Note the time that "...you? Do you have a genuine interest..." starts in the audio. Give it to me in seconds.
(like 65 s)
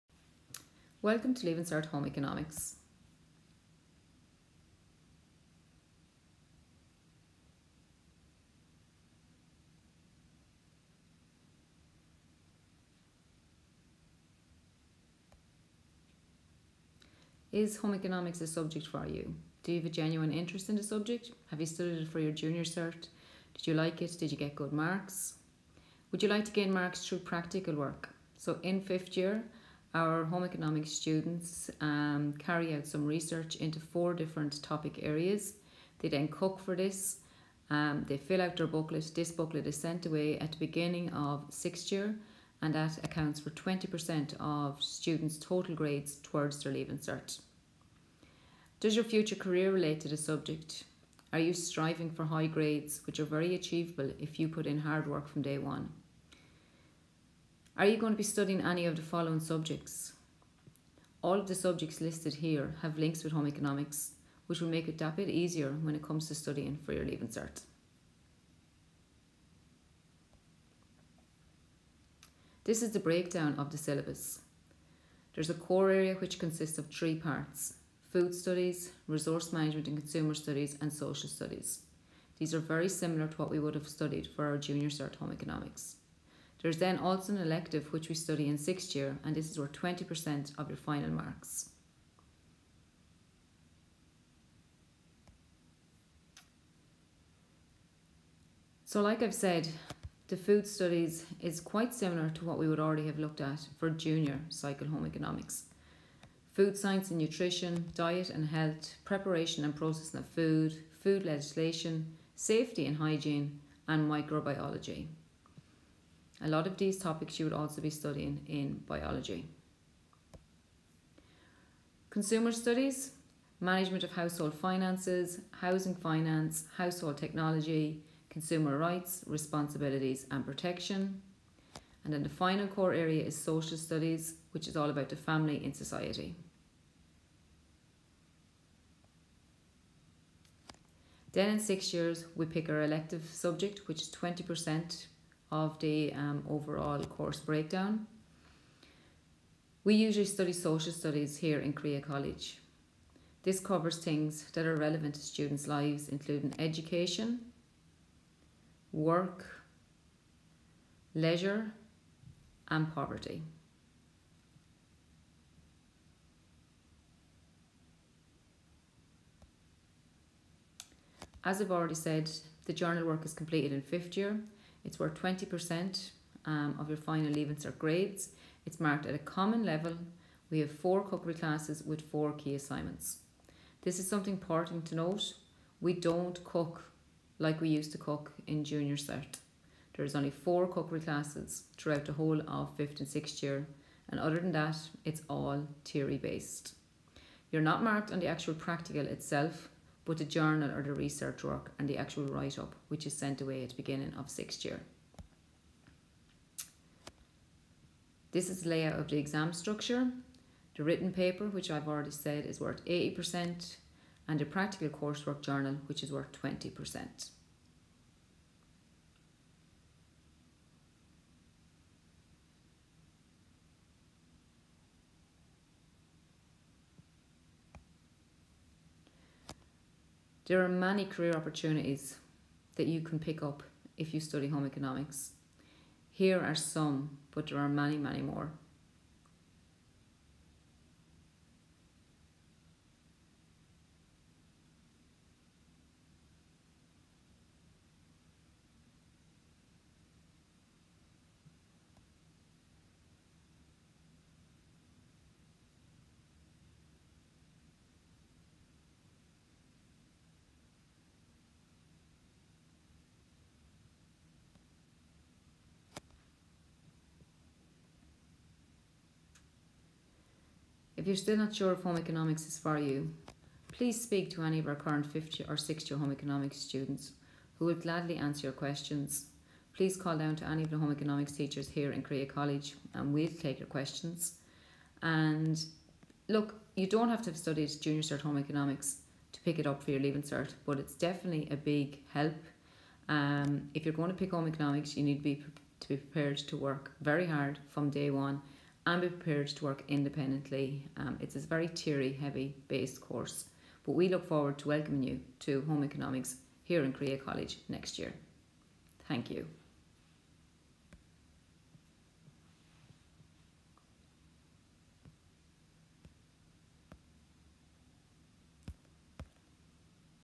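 19 s.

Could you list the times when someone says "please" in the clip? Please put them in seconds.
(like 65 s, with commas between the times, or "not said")
273 s, 279 s.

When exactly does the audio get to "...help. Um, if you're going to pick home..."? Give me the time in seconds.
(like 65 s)
292 s.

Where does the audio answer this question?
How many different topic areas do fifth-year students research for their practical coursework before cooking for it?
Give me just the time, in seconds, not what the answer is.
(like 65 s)
33 s.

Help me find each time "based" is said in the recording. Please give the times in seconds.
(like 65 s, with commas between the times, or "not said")
196 s, 302 s.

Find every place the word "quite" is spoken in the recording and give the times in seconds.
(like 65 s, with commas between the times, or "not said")
101 s.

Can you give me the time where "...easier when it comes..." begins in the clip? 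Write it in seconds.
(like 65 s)
65 s.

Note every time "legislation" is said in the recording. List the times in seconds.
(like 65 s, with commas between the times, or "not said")
111 s.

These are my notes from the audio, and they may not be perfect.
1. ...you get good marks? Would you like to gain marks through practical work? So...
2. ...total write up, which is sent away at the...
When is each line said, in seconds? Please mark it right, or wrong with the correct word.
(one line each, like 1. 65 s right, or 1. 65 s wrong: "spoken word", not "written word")
1. 24 s right
2. 201 s wrong: "actual", not "total".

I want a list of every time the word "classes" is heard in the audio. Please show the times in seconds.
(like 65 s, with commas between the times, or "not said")
181 s, 190 s.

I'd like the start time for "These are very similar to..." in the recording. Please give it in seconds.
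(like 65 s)
82 s.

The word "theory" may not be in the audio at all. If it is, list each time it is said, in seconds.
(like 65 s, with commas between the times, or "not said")
195 s, 301 s.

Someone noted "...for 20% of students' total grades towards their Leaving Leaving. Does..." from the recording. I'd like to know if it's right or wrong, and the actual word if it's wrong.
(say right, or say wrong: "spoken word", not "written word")
wrong: "Cert", not "Leaving".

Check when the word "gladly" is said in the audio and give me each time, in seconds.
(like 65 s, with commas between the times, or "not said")
277 s.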